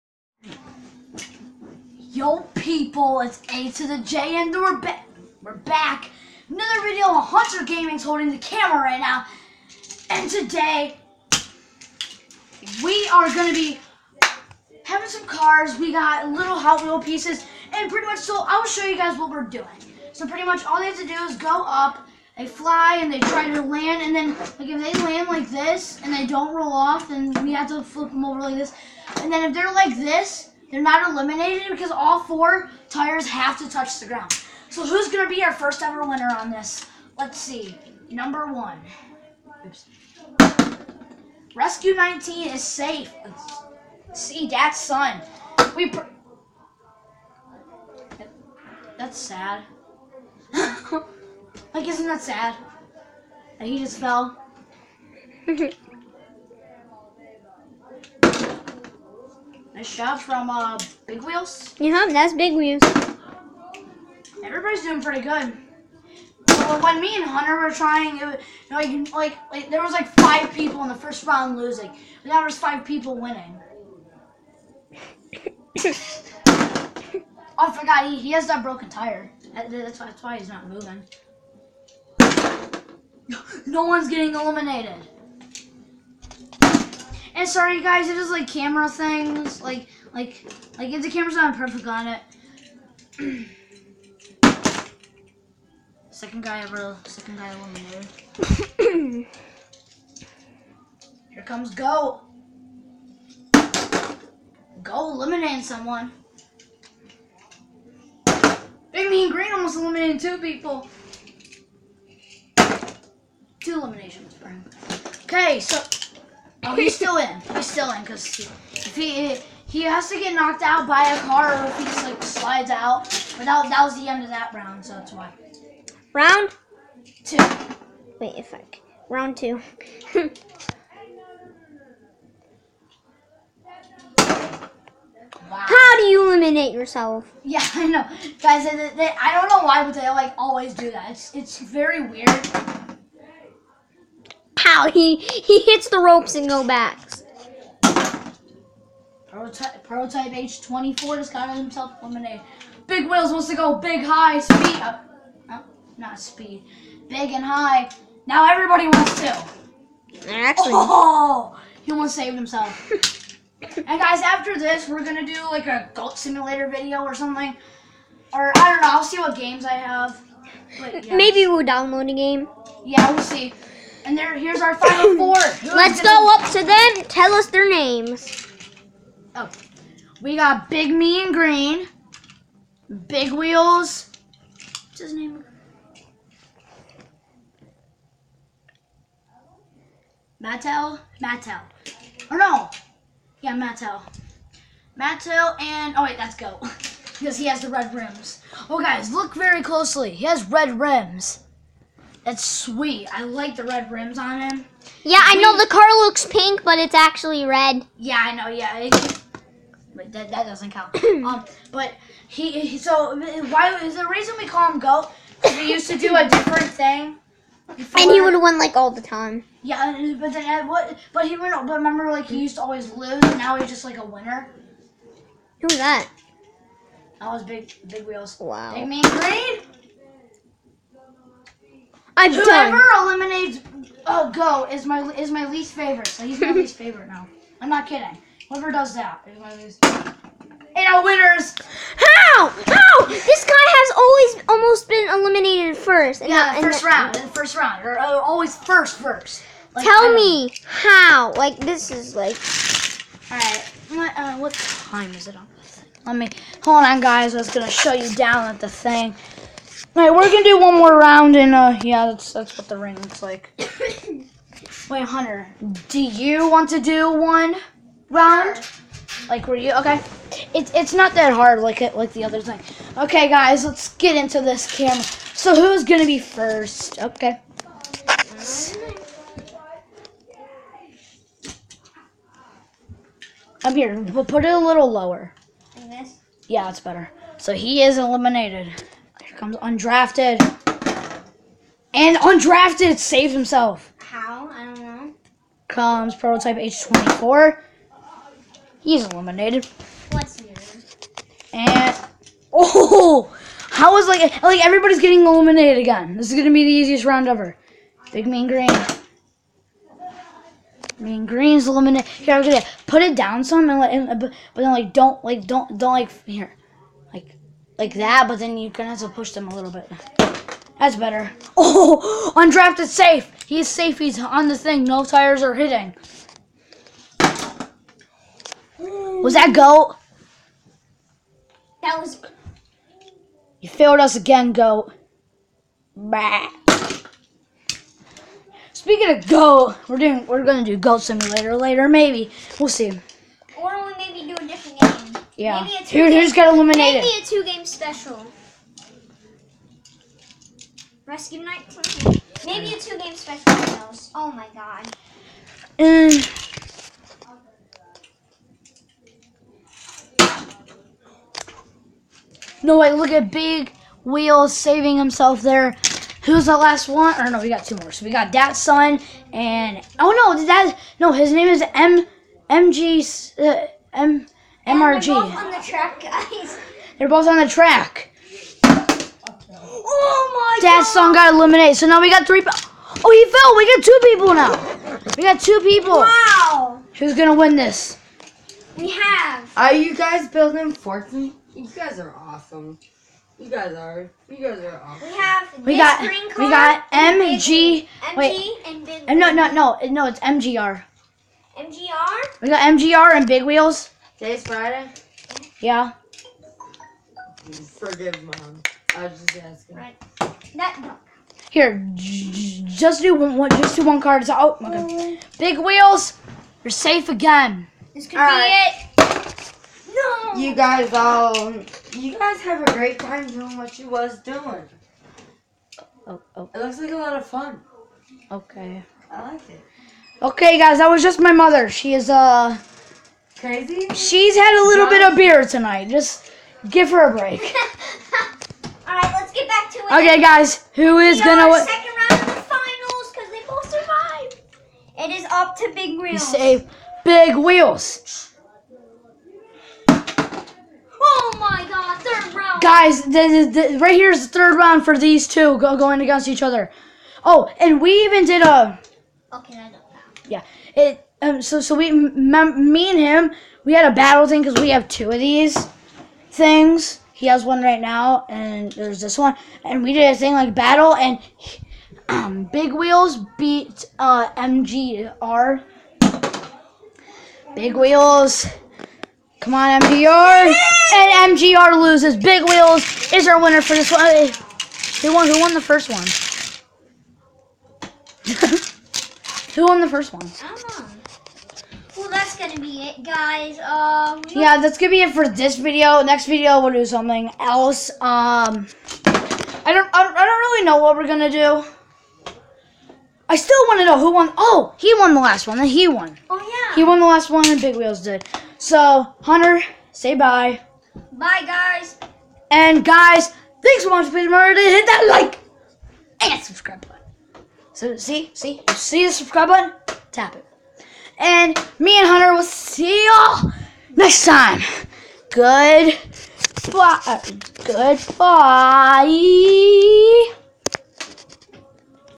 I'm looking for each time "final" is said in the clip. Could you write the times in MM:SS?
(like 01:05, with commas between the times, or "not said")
02:54, 07:22.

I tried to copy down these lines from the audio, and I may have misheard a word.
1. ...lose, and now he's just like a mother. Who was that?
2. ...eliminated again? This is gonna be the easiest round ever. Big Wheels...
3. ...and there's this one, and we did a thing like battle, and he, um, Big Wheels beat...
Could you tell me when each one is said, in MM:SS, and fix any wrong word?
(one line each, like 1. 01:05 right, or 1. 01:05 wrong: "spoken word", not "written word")
1. 03:42 wrong: "winner", not "mother"
2. 05:05 wrong: "Mean", not "Wheels"
3. 07:48 right.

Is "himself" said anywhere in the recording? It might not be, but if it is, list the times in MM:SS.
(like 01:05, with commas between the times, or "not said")
02:31, 02:42, 04:53, 06:04.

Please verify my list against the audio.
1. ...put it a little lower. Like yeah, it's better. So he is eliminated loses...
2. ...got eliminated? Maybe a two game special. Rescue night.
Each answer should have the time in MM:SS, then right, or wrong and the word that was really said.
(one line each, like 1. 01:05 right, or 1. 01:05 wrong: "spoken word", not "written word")
1. 04:44 wrong: "comes", not "loses"
2. 05:46 right.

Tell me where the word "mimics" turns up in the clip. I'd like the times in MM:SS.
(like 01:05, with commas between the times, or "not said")
not said.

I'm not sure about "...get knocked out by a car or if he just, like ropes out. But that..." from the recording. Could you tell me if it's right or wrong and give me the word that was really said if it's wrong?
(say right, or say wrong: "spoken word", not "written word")
wrong: "slides", not "ropes".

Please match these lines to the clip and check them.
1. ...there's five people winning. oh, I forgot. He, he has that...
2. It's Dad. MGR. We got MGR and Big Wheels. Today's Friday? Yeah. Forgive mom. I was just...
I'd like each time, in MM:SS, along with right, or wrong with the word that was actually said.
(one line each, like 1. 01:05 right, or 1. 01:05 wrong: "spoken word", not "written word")
1. 01:12 right
2. 06:40 wrong: "MGR", not "Dad".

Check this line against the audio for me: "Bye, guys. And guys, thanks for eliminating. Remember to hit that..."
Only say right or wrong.
wrong.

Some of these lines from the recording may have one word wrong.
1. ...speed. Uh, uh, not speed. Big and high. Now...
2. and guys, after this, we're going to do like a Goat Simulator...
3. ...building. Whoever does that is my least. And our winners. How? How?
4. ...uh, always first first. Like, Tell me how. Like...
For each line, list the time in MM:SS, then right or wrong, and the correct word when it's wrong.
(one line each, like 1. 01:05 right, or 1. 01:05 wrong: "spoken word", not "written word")
1. 02:34 right
2. 02:43 right
3. 03:57 wrong: "kidding", not "building"
4. 04:07 right.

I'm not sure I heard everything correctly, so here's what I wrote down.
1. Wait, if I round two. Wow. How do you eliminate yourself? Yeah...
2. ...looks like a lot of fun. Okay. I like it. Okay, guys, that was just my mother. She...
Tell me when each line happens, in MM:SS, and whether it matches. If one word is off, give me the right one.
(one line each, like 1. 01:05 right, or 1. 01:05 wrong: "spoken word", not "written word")
1. 02:08 right
2. 07:06 right.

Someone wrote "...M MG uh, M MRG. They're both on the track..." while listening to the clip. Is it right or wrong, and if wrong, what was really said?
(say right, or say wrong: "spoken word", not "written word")
right.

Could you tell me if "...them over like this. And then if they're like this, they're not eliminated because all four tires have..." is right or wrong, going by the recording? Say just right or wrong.
right.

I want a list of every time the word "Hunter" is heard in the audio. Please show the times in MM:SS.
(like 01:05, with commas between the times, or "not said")
00:07, 01:07, 04:25, 08:29, 08:42.